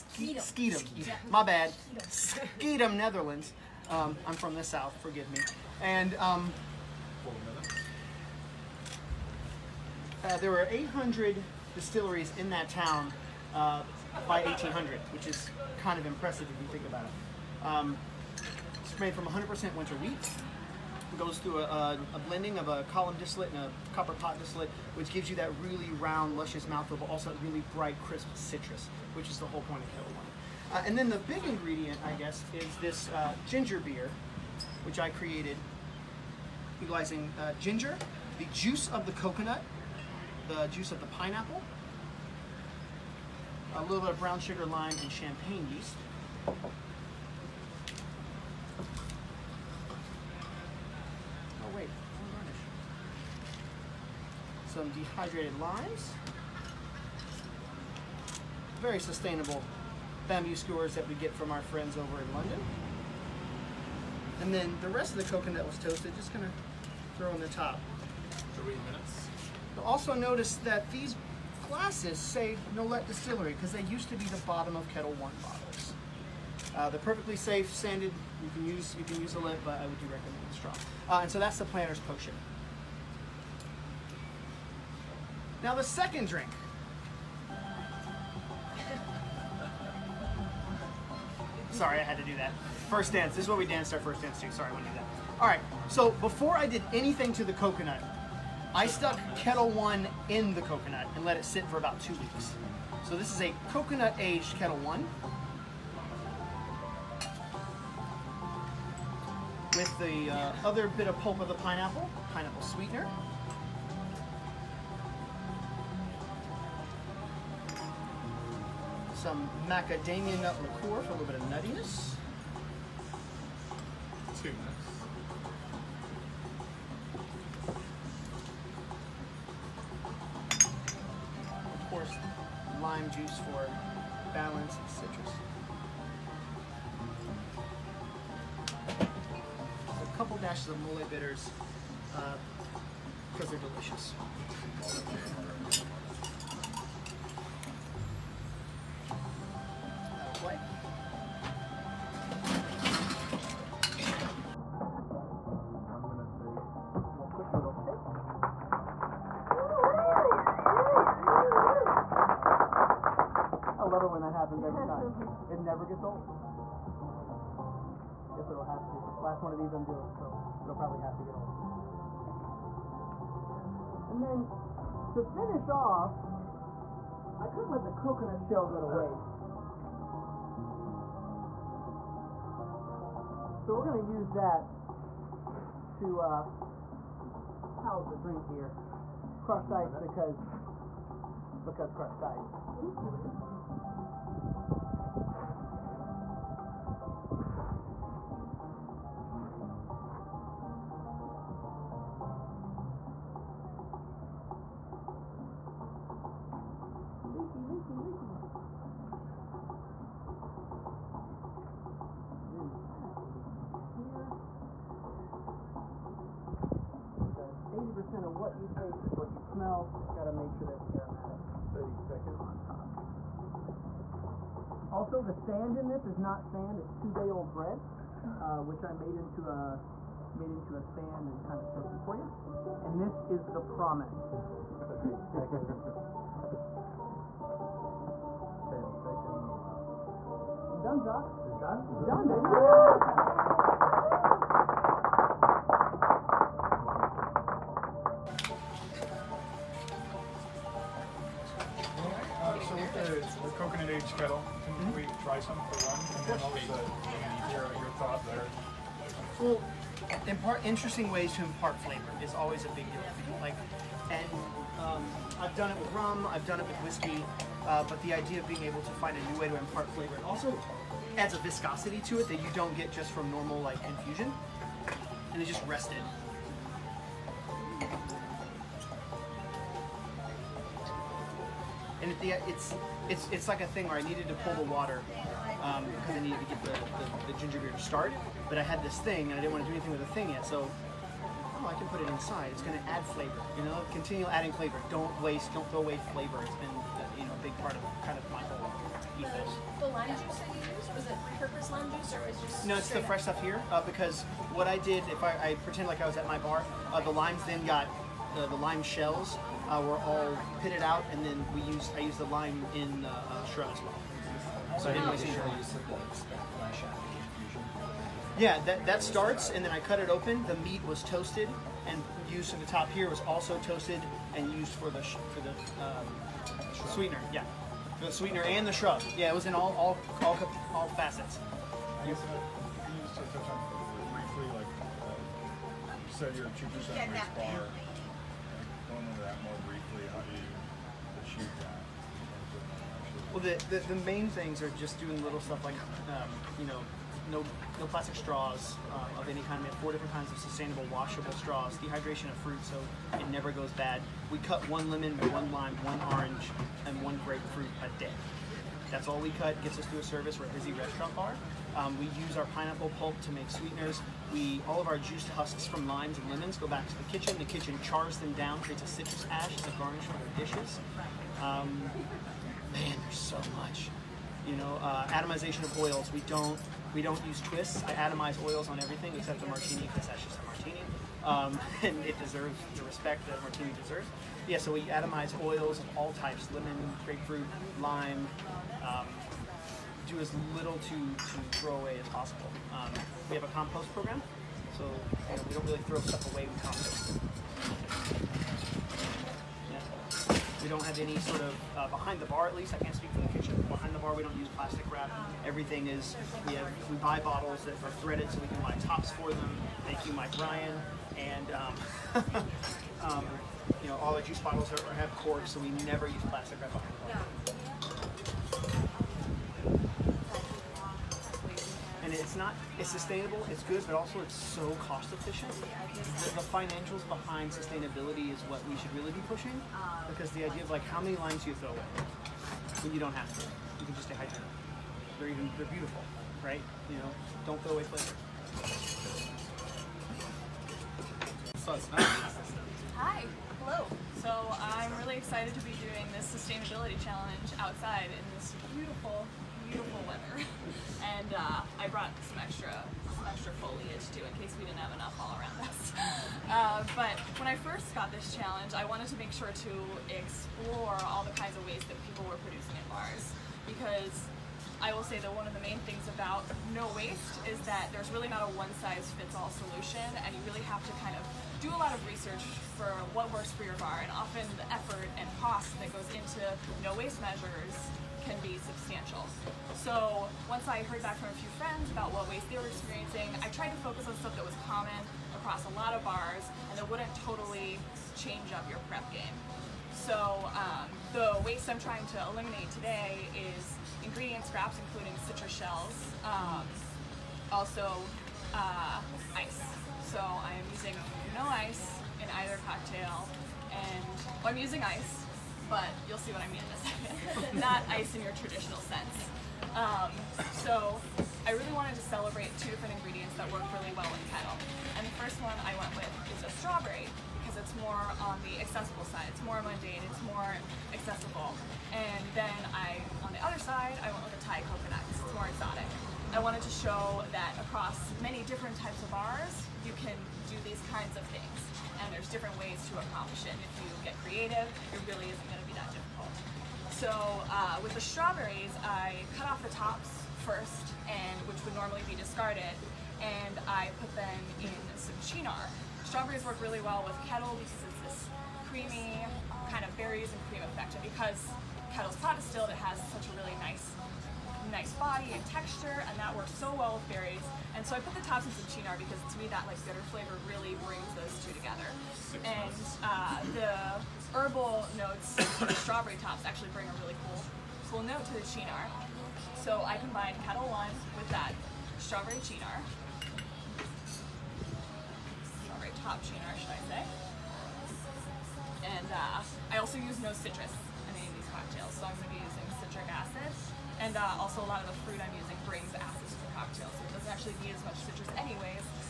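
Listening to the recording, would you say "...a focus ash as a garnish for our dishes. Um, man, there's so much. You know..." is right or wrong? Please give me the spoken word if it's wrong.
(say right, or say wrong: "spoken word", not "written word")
wrong: "citrus", not "focus".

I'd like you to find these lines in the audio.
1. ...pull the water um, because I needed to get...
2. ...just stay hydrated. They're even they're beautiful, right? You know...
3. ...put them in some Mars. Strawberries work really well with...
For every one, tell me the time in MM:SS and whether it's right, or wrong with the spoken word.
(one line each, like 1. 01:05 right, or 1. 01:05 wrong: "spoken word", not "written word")
1. 04:44 right
2. 07:13 right
3. 09:03 wrong: "Cynar", not "Mars".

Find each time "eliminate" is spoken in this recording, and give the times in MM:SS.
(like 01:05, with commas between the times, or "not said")
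08:12.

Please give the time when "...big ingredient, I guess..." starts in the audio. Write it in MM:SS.
00:31.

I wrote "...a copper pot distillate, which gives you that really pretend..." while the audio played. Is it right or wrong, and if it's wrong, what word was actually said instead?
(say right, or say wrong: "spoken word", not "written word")
wrong: "round", not "pretend".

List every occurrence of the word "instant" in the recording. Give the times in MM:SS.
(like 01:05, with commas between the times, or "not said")
not said.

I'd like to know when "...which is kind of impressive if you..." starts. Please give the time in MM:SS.
00:15.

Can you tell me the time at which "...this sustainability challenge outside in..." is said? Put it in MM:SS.
07:26.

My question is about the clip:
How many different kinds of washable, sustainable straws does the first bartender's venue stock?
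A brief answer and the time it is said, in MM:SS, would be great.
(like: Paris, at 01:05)
4, at 05:49.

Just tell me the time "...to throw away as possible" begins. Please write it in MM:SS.
06:31.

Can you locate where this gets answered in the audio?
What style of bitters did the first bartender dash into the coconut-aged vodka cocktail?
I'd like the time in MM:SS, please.
02:20.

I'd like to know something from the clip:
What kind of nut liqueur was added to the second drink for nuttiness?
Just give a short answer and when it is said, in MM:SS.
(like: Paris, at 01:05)
macadamia nut liqueur, at 01:59.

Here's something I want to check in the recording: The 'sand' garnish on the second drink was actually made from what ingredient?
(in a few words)
two-day-old bread.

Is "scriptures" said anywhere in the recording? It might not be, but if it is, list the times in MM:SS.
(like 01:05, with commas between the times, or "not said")
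not said.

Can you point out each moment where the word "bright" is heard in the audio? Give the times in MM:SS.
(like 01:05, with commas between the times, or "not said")
00:27.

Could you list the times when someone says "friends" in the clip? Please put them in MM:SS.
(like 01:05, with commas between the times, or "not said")
01:01, 08:01.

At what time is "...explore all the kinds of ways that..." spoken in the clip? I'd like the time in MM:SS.
07:40.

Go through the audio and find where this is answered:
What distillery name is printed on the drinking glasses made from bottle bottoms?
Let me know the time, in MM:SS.
01:12.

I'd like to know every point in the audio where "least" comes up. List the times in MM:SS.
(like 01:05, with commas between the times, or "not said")
06:42.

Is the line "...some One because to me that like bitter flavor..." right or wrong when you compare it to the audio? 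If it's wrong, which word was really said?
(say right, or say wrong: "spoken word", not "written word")
wrong: "Cynar", not "One".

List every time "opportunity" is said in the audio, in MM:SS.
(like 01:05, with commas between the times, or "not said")
not said.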